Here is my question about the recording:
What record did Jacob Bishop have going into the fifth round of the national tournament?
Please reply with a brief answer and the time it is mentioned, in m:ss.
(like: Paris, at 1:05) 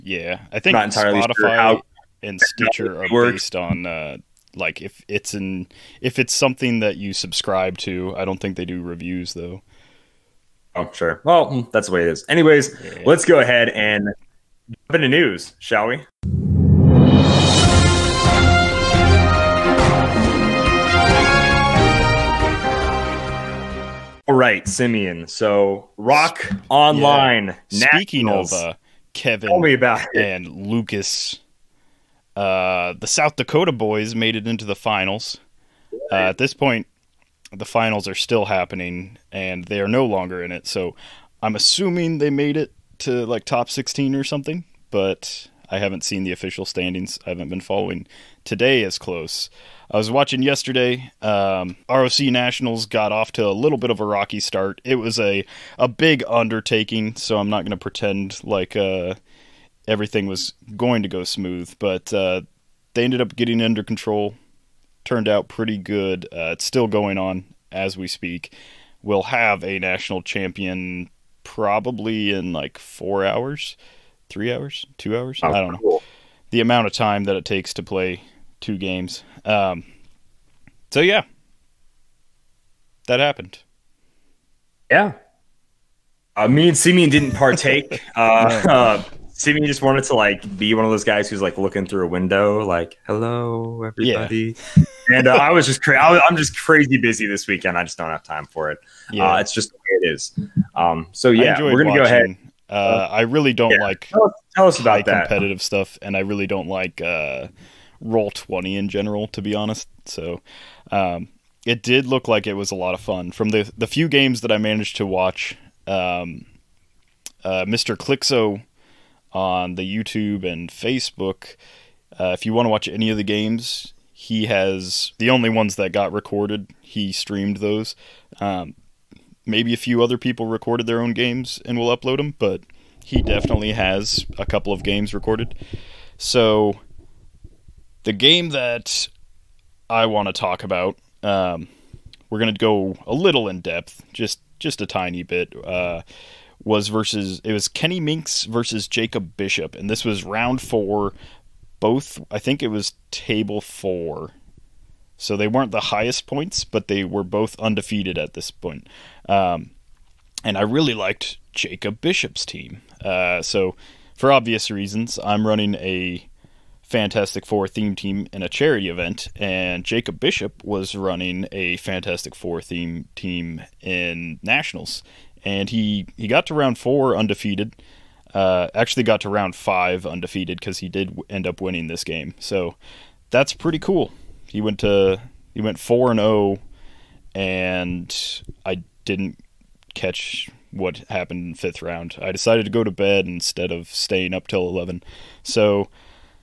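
4 and 0, at 3:05.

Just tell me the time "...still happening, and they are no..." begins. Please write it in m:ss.
0:38.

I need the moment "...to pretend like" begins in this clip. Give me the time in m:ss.
0:57.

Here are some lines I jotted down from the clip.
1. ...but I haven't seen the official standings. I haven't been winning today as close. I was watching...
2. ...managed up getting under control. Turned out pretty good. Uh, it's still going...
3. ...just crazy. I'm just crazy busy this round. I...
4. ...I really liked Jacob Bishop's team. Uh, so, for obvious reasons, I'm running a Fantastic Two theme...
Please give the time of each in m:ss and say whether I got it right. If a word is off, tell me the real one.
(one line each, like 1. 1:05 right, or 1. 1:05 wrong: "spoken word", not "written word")
1. 0:44 wrong: "following", not "winning"
2. 1:03 wrong: "ended", not "managed"
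3. 1:35 wrong: "weekend", not "round"
4. 2:40 wrong: "Four", not "Two".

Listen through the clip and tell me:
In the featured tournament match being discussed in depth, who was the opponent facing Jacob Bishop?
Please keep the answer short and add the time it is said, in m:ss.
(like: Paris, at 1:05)
Kenny Minks, at 2:27.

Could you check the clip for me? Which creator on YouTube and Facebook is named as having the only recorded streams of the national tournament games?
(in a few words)
Mr. Clixo.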